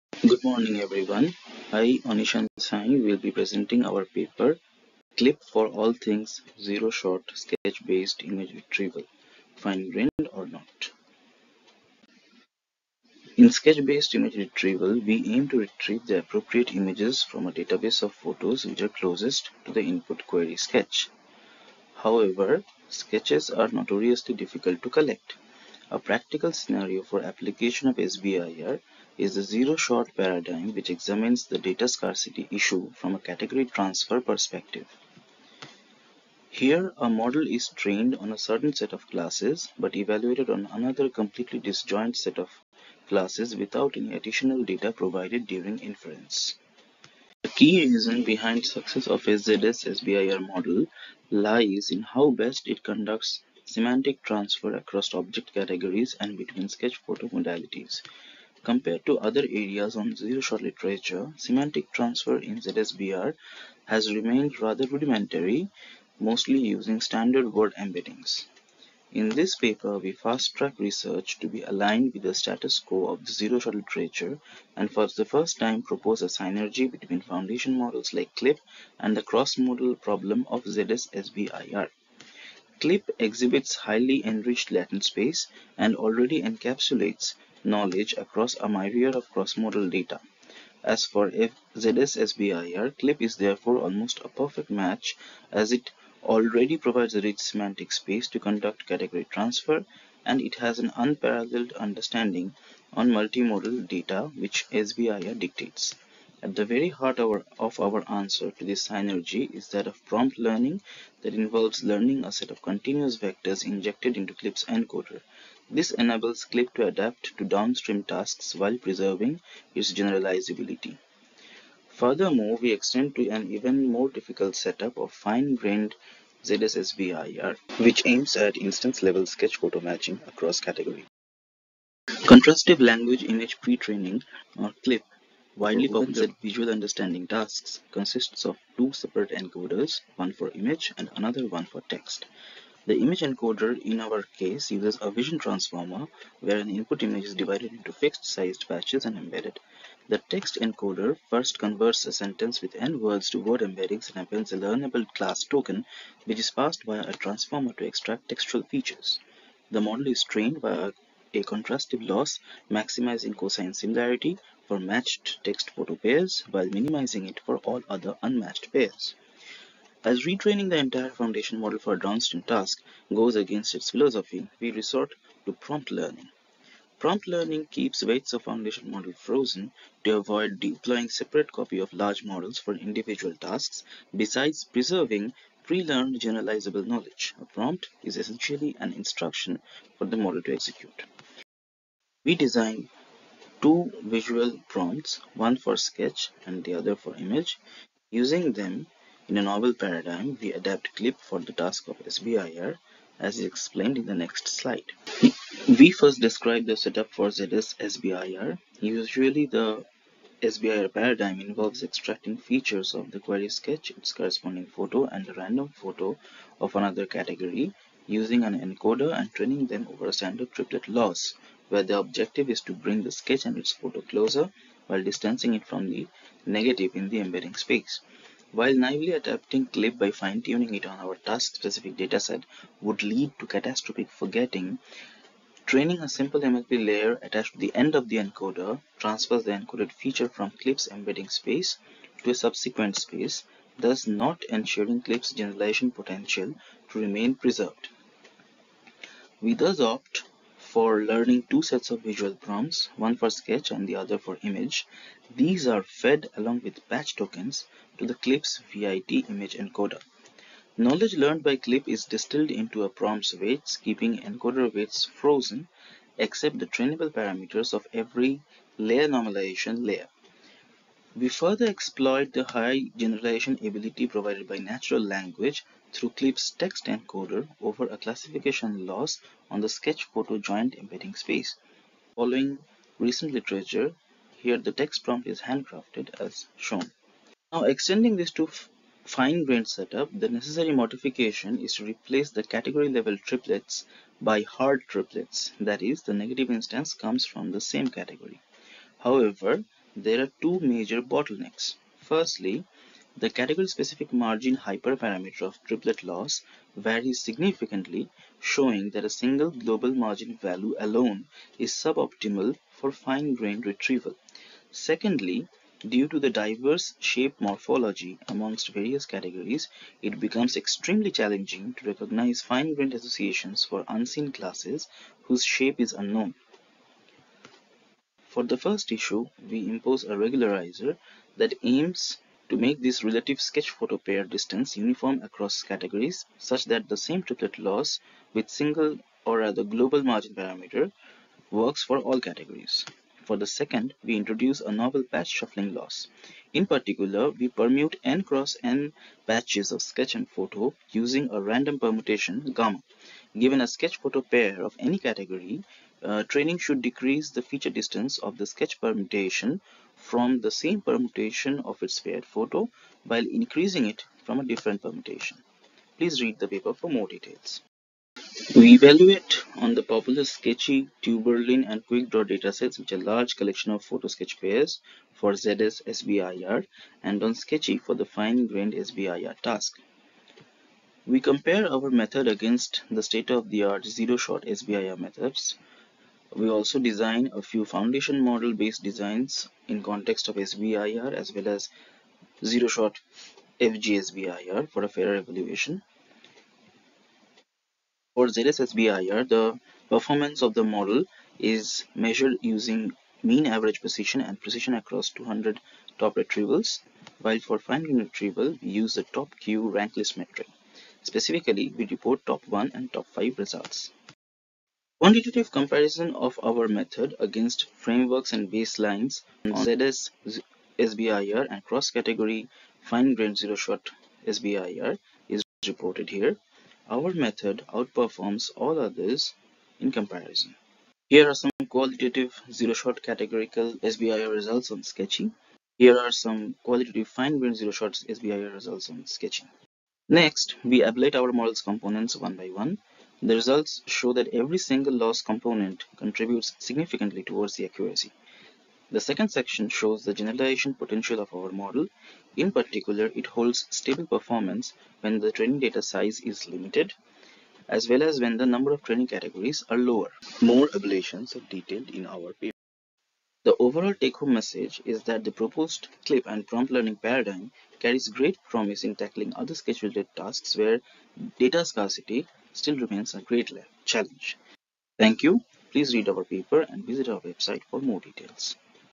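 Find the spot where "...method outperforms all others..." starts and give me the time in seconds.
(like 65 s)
427 s.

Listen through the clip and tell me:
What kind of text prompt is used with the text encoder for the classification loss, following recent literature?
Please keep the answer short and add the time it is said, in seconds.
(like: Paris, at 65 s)
Handcrafted, at 285 s.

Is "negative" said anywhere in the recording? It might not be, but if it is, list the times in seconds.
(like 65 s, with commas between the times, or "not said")
226 s, 296 s.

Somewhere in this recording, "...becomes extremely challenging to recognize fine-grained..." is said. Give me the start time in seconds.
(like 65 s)
320 s.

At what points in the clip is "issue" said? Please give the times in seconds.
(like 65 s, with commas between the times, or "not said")
32 s, 328 s.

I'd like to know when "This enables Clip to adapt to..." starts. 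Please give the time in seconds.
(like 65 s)
115 s.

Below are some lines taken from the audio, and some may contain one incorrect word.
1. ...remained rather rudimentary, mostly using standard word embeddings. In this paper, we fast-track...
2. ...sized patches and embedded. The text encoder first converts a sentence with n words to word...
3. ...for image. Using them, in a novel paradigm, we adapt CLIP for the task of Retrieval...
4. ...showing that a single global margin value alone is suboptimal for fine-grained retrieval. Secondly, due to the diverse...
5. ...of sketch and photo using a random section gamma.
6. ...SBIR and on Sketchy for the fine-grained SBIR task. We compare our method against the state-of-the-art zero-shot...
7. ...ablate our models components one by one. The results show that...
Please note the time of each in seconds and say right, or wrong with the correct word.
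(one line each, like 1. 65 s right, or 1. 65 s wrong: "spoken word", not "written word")
1. 64 s right
2. 148 s right
3. 196 s wrong: "SBIR", not "Retrieval"
4. 308 s right
5. 349 s wrong: "permutation", not "section"
6. 375 s right
7. 440 s right.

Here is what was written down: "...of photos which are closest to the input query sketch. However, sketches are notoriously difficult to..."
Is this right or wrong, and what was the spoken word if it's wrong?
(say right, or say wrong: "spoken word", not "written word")
right.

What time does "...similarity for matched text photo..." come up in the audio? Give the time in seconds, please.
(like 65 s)
163 s.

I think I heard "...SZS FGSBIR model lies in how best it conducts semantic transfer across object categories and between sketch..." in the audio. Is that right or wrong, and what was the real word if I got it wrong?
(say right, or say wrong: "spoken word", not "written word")
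wrong: "SBIR", not "FGSBIR".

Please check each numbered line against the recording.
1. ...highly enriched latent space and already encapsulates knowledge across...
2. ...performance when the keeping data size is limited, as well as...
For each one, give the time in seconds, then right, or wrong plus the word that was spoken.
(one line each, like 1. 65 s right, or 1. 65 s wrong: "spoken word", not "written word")
1. 83 s right
2. 454 s wrong: "training", not "keeping".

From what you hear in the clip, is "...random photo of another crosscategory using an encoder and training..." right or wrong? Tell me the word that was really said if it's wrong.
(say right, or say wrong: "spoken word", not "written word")
wrong: "category", not "crosscategory".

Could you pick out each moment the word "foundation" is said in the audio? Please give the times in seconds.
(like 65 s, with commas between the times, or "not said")
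77 s, 171 s, 178 s, 387 s.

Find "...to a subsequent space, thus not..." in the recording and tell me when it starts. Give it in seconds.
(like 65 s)
242 s.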